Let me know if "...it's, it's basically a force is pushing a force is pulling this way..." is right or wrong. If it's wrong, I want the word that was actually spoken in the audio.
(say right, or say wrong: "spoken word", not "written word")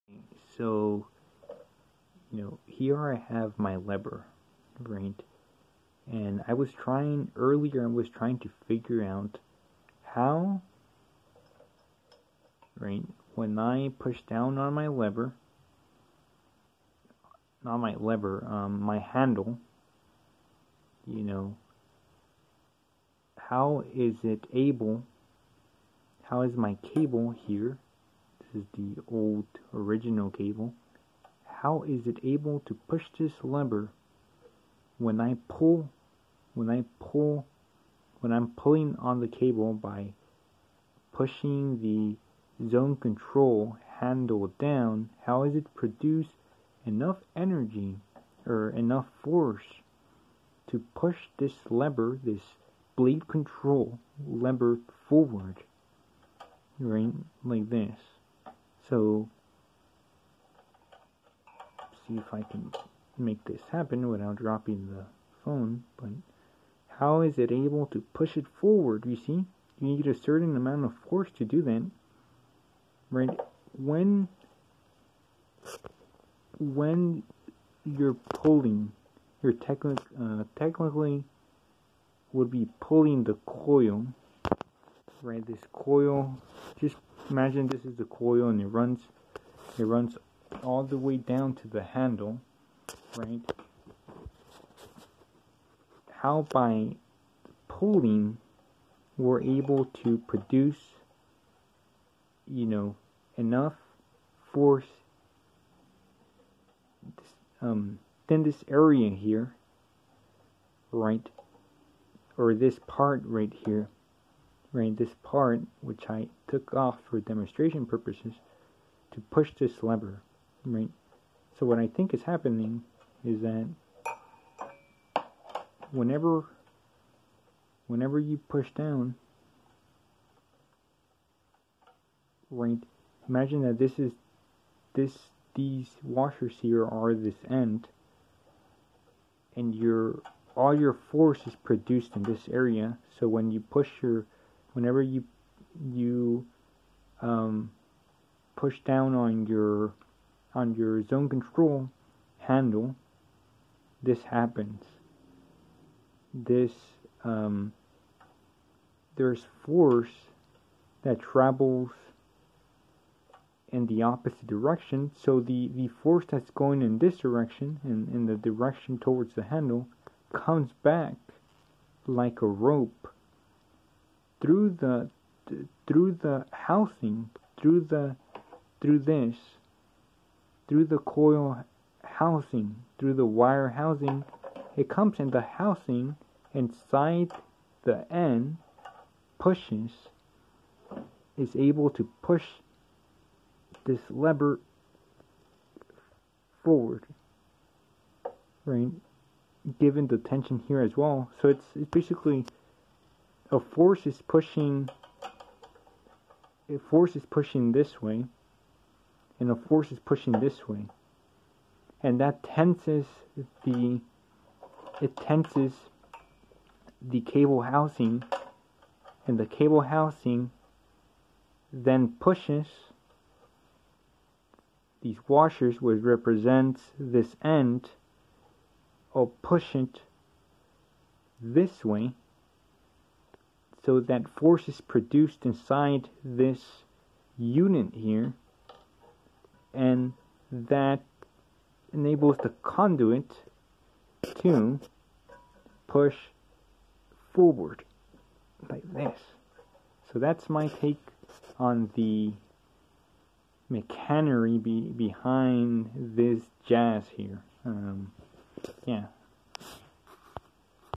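wrong: "pushing", not "pulling".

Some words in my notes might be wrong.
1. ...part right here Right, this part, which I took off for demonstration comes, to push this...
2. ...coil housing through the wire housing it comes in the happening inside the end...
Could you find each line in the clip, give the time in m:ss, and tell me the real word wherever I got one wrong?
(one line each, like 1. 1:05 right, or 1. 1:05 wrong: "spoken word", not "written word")
1. 1:52 wrong: "purposes", not "comes"
2. 3:00 wrong: "housing", not "happening".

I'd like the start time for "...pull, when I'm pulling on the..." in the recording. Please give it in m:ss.
0:36.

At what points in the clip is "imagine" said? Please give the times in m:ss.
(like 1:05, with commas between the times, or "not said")
1:27, 2:13.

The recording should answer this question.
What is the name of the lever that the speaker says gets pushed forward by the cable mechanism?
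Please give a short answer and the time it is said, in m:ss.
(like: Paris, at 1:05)
blade control lever, at 0:52.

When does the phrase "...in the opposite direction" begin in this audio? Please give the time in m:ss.
2:43.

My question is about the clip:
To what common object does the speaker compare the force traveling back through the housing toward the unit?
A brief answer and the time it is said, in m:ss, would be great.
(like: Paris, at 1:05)
a rope, at 2:52.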